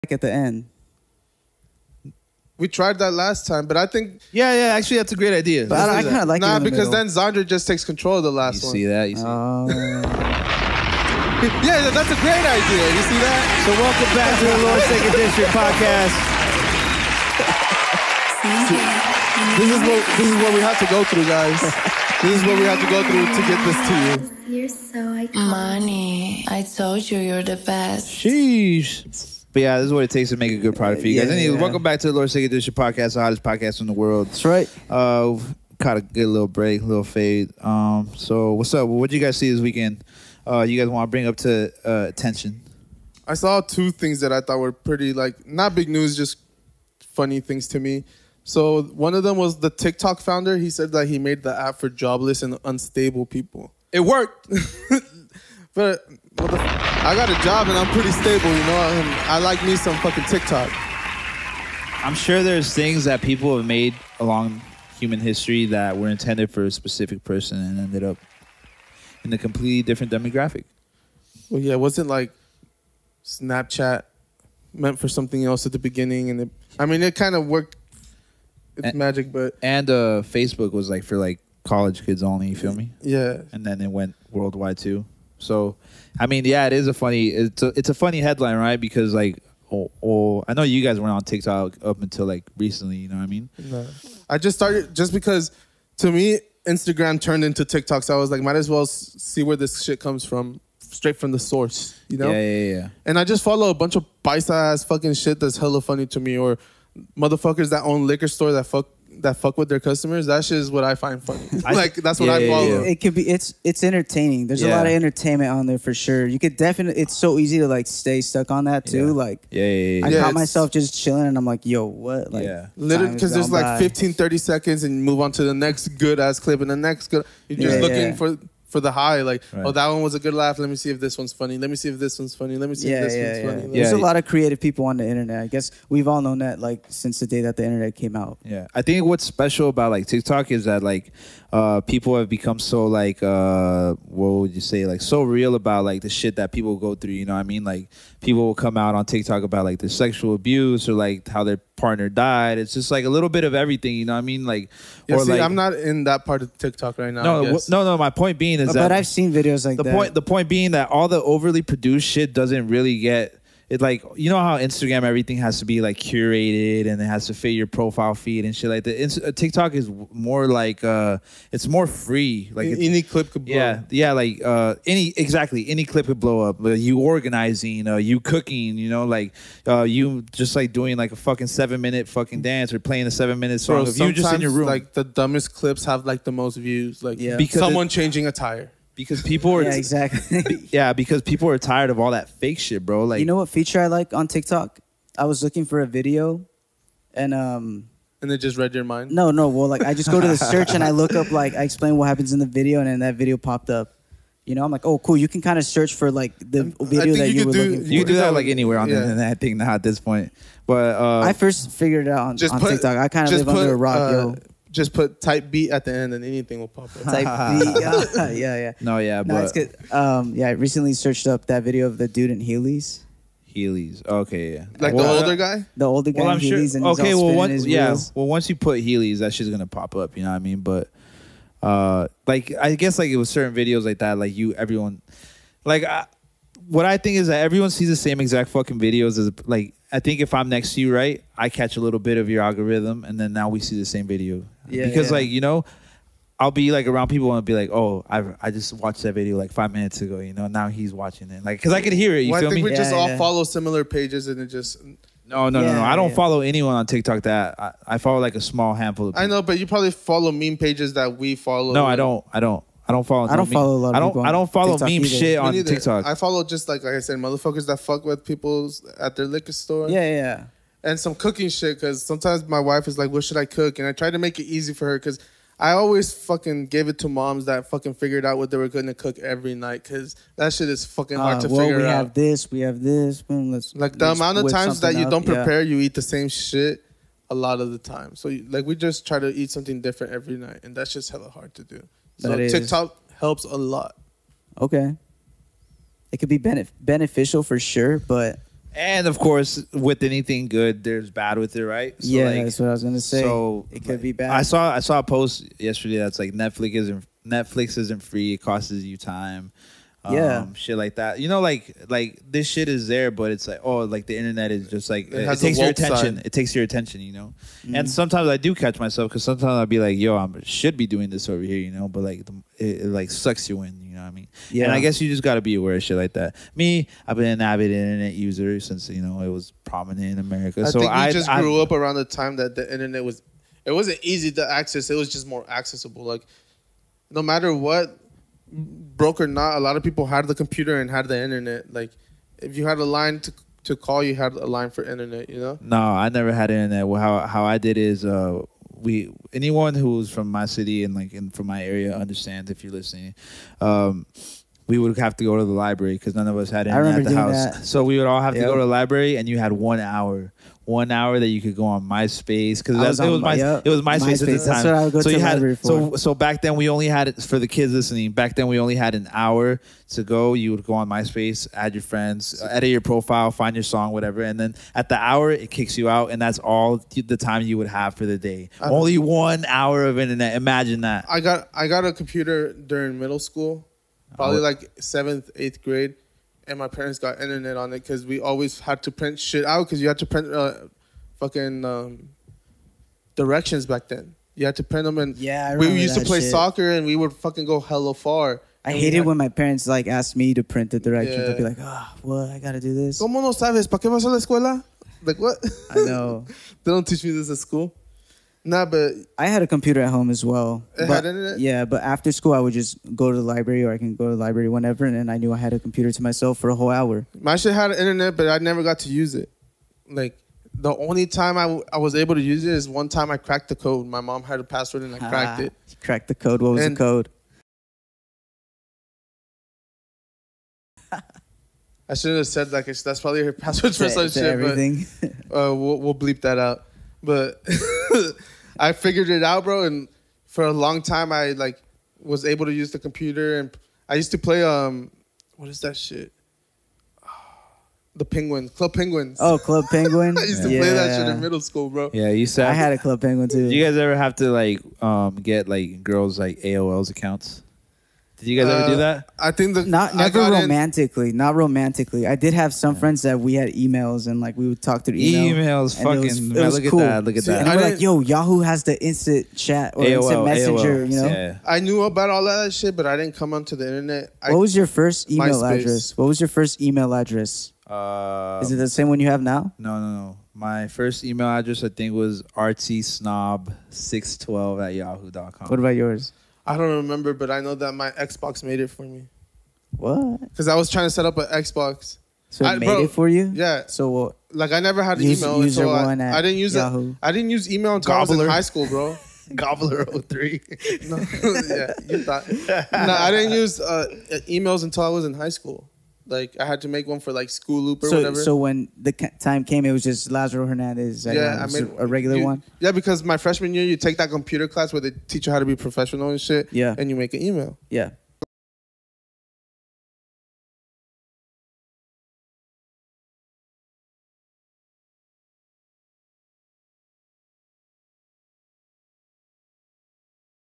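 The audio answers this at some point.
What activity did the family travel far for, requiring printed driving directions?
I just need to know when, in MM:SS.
06:36.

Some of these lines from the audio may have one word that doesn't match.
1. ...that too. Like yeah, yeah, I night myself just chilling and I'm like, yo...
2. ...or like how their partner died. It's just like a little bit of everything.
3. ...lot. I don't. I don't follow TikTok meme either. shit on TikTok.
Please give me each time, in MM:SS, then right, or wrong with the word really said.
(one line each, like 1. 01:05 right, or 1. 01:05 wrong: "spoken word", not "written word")
1. 01:58 wrong: "caught", not "night"
2. 02:30 right
3. 04:23 right.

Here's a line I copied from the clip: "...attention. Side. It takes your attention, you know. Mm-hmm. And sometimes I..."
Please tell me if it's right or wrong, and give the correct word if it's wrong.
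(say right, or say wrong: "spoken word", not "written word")
right.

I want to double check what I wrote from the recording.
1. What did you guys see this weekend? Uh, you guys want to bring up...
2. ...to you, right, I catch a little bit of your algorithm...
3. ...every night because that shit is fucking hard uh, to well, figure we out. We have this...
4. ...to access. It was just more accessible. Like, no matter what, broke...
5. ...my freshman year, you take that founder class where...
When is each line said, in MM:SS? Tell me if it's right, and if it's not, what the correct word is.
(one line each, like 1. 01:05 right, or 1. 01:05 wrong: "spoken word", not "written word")
1. 00:38 right
2. 04:00 right
3. 04:39 right
4. 05:34 right
5. 08:33 wrong: "computer", not "founder".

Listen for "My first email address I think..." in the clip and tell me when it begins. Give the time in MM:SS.
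08:00.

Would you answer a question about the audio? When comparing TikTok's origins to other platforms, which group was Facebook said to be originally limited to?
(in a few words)
College kids.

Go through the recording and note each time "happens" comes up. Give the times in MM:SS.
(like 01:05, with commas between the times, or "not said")
03:22.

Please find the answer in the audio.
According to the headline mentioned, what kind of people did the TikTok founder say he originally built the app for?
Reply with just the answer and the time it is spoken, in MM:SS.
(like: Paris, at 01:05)
Jobless and unstable people, at 00:51.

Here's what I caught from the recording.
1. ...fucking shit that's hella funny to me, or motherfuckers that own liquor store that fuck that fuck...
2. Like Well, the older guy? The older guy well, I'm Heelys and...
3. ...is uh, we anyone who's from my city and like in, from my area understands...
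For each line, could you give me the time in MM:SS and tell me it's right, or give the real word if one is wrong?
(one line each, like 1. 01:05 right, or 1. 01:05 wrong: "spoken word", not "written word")
1. 01:44 right
2. 03:44 right
3. 05:47 right.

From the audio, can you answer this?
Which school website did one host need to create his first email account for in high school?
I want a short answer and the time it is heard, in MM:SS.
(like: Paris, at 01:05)
School Loop, at 08:27.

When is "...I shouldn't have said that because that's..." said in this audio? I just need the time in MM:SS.
07:10.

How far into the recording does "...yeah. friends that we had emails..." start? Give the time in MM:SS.
07:42.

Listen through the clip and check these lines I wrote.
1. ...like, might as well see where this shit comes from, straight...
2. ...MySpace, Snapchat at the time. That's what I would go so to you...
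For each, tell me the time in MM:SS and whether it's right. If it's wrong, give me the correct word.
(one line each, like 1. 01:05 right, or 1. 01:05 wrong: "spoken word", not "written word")
1. 01:38 right
2. 06:03 wrong: "MySpace", not "Snapchat".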